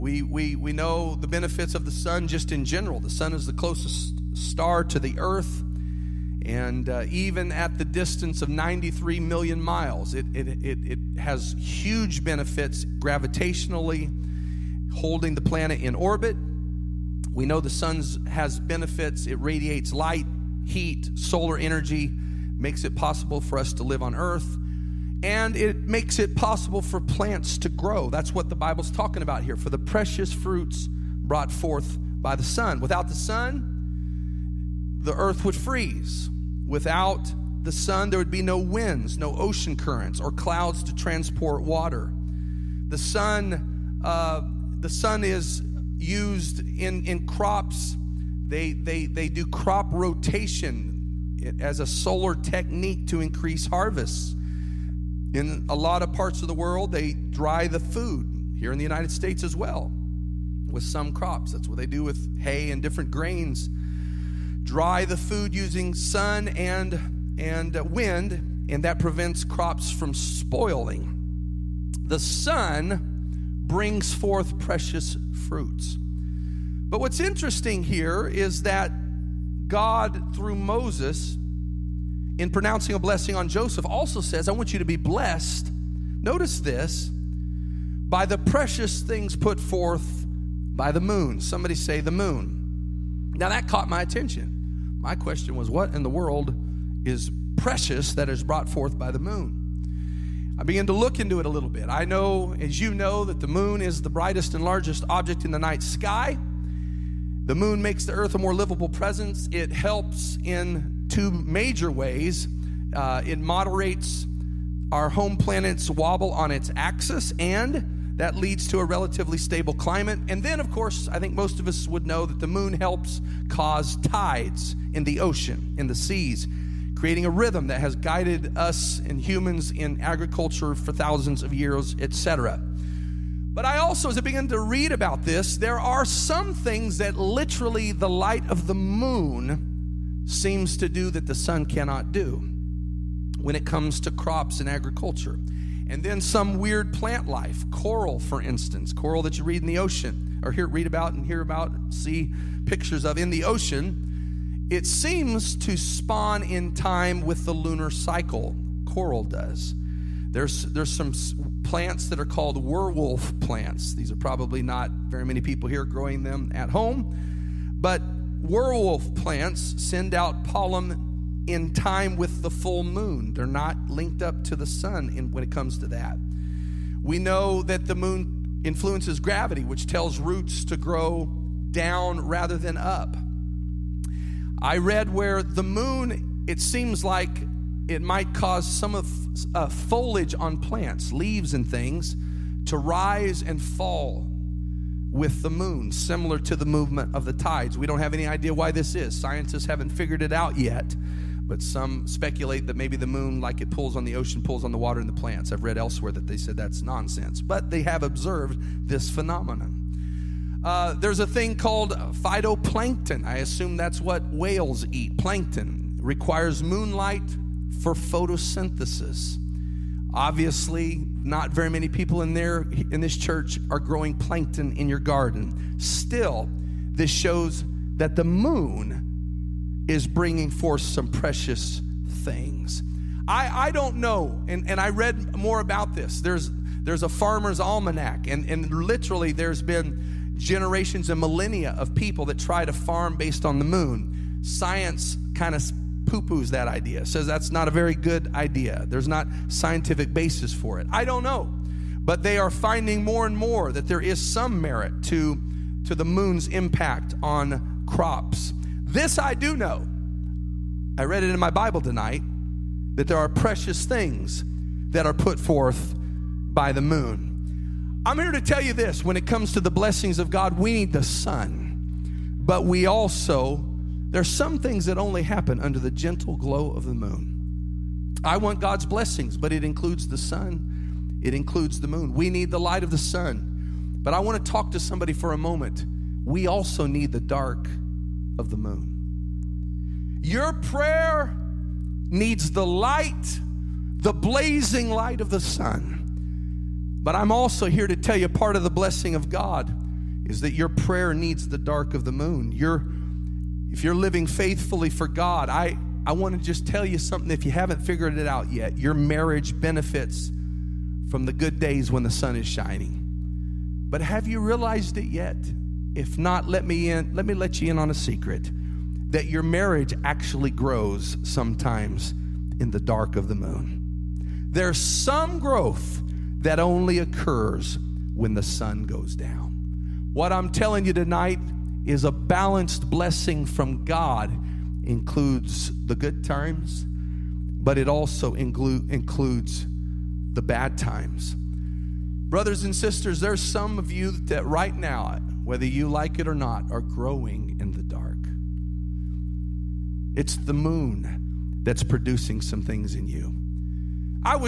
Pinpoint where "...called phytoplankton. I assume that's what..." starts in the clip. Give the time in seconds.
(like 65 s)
211 s.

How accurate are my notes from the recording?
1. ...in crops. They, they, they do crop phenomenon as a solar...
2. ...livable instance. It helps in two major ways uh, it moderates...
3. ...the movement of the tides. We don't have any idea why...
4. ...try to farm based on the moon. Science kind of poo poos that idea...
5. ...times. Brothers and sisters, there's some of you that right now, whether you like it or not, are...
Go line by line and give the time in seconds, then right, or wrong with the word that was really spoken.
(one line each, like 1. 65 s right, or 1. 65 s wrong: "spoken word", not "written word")
1. 47 s wrong: "rotation", not "phenomenon"
2. 108 s wrong: "presence", not "instance"
3. 196 s right
4. 242 s right
5. 340 s right.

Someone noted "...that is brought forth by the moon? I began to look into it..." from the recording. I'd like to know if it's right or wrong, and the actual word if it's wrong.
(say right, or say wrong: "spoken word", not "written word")
right.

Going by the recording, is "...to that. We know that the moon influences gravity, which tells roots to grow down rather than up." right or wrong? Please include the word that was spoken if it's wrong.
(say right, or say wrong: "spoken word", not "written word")
right.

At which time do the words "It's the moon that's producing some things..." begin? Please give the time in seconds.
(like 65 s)
350 s.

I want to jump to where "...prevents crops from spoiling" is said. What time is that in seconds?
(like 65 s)
68 s.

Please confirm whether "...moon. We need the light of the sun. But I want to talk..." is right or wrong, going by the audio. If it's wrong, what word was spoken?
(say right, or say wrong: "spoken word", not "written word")
right.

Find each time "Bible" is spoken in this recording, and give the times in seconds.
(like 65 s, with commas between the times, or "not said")
28 s, 261 s.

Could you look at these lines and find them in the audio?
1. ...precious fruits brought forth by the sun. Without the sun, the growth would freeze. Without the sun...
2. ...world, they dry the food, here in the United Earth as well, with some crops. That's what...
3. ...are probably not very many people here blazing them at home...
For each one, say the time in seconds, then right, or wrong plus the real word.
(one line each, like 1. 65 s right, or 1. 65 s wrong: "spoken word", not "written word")
1. 29 s wrong: "earth", not "growth"
2. 56 s wrong: "States", not "Earth"
3. 164 s wrong: "growing", not "blazing".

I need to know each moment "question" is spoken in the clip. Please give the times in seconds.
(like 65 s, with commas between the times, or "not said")
95 s.